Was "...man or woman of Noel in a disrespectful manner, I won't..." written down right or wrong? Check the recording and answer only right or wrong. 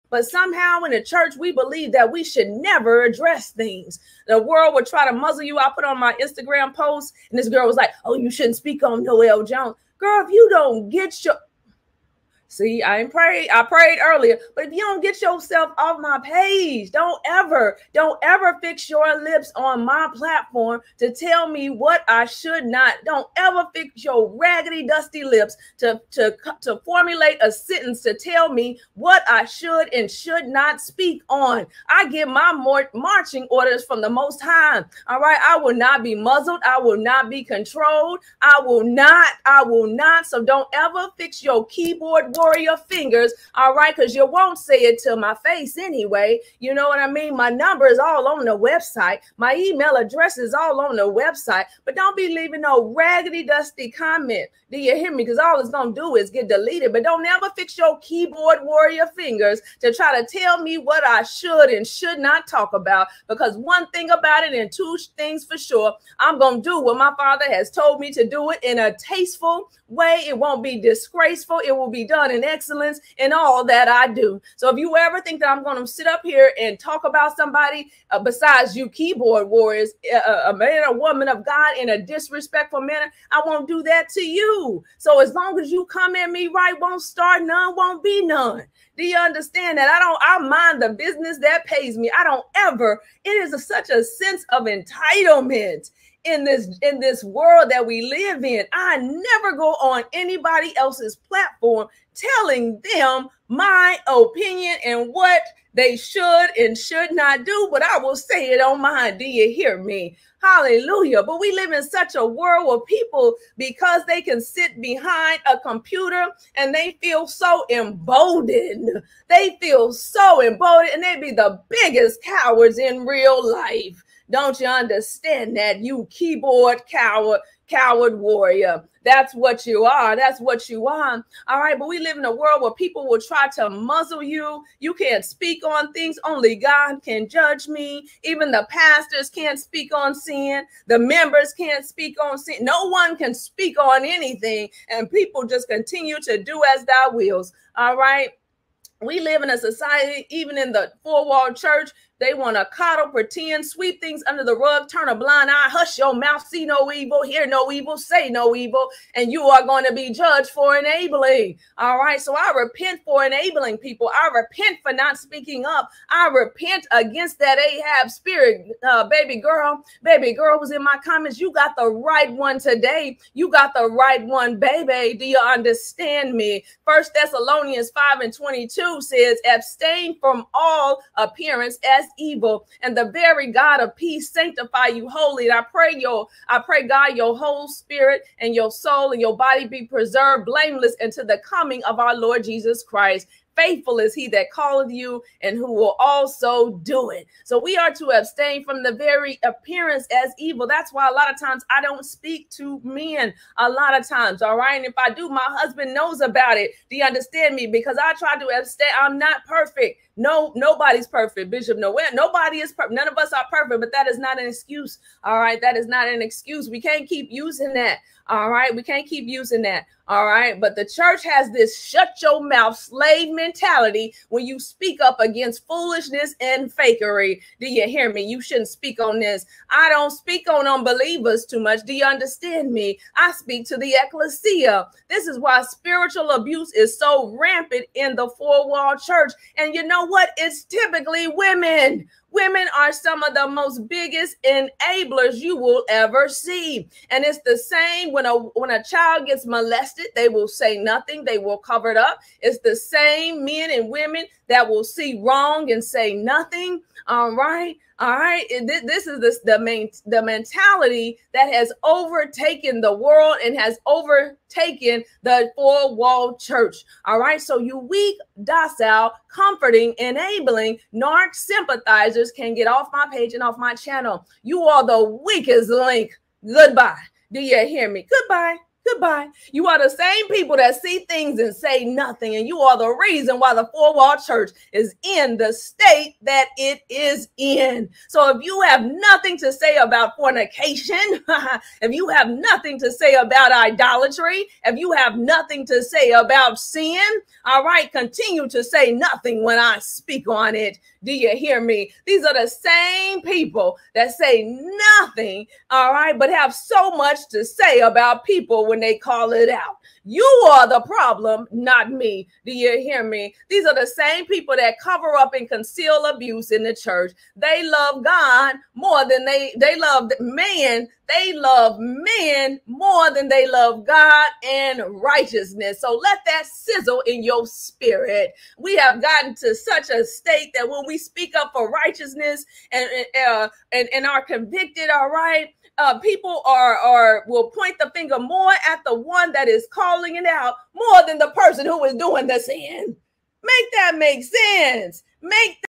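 wrong.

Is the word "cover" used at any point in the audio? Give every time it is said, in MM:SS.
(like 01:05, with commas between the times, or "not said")
04:11, 05:14.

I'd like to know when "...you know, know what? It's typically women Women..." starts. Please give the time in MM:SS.
03:59.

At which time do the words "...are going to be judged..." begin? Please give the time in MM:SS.
02:39.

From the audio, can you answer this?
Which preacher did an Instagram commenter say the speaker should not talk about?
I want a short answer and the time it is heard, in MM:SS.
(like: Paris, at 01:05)
Noel Jones, at 00:09.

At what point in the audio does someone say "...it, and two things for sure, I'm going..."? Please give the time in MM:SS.
01:04.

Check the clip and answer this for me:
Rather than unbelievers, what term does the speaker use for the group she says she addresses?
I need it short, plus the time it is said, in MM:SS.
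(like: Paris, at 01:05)
ecclesia, at 03:54.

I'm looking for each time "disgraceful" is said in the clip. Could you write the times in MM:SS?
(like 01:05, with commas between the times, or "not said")
01:10.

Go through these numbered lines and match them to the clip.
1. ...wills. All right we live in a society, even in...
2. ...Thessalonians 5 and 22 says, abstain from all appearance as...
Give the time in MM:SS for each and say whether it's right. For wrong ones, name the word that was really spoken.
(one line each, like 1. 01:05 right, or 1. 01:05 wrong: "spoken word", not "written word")
1. 02:27 right
2. 02:57 right.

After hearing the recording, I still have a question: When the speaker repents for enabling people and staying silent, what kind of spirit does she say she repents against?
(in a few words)
Ahab spirit.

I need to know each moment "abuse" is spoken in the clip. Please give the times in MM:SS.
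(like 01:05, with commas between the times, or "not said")
03:56, 05:16.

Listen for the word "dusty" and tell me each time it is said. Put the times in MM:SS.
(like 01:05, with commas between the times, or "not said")
00:24, 00:53.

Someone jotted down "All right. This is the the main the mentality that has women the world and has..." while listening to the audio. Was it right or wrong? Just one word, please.
wrong.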